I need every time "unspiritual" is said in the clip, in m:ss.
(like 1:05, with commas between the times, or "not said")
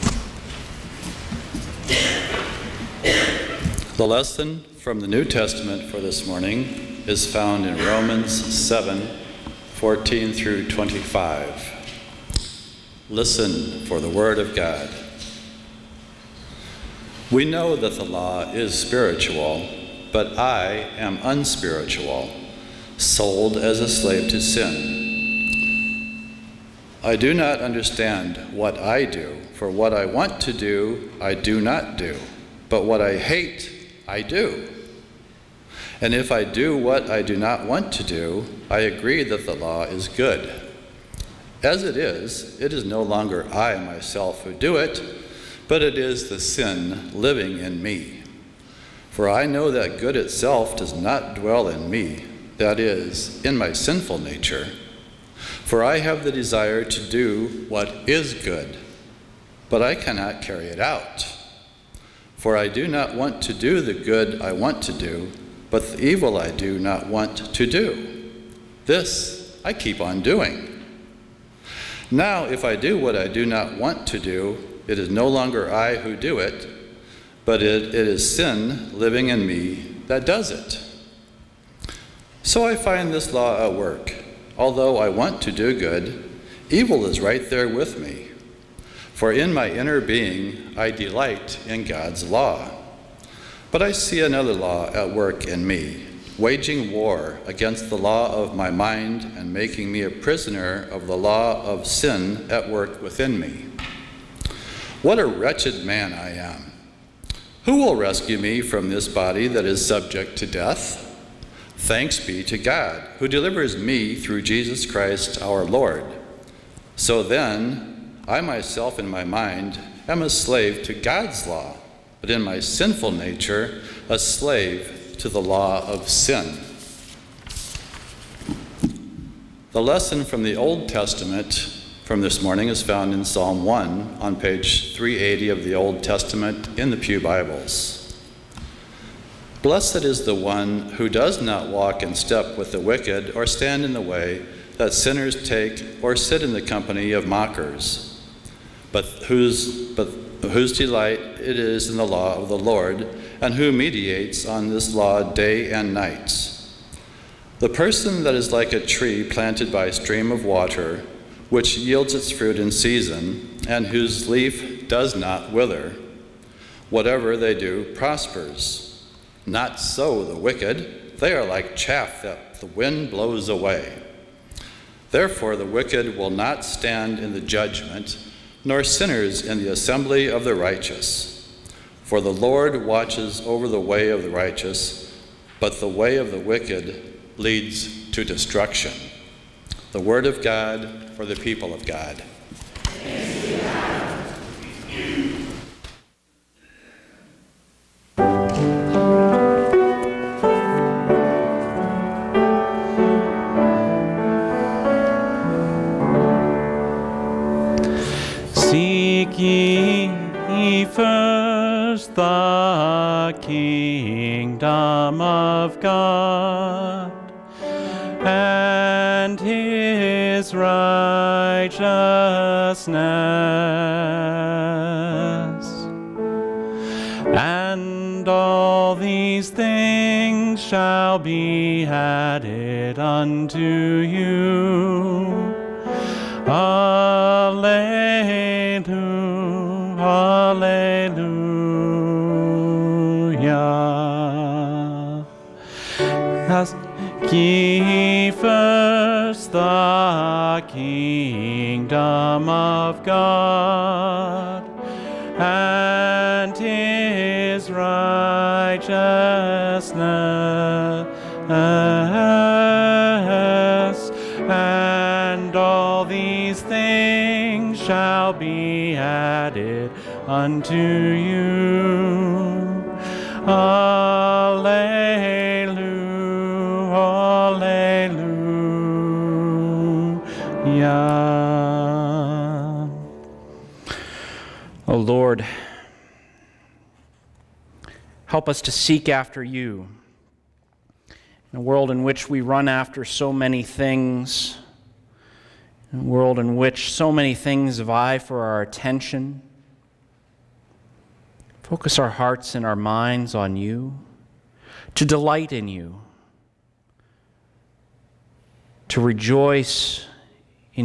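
0:21.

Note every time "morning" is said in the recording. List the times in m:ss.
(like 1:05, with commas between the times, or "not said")
0:06, 2:12.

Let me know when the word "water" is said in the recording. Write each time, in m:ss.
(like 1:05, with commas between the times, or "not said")
2:40.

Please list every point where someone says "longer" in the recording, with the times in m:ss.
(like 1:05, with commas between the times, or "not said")
0:43, 1:15.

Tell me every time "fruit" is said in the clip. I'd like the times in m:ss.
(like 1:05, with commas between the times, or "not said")
2:42.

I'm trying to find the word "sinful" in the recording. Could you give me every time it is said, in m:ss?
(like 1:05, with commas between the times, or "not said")
0:53, 2:02.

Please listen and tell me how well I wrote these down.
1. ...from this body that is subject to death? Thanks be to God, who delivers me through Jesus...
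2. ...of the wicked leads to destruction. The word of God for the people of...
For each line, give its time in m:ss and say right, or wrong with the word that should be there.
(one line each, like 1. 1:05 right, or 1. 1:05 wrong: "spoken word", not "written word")
1. 1:48 right
2. 3:06 right.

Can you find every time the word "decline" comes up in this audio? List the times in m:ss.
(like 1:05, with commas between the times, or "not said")
not said.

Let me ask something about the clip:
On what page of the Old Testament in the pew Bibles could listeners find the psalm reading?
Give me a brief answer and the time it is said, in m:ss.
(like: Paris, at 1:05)
380, at 2:14.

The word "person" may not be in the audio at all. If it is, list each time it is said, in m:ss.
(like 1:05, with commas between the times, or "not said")
2:37.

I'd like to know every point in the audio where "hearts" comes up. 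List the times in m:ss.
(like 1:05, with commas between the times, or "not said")
5:02.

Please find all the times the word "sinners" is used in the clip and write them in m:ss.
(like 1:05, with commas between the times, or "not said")
2:24, 2:58.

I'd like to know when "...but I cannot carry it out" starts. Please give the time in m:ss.
0:59.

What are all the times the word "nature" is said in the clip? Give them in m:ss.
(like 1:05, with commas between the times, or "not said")
0:54, 2:03.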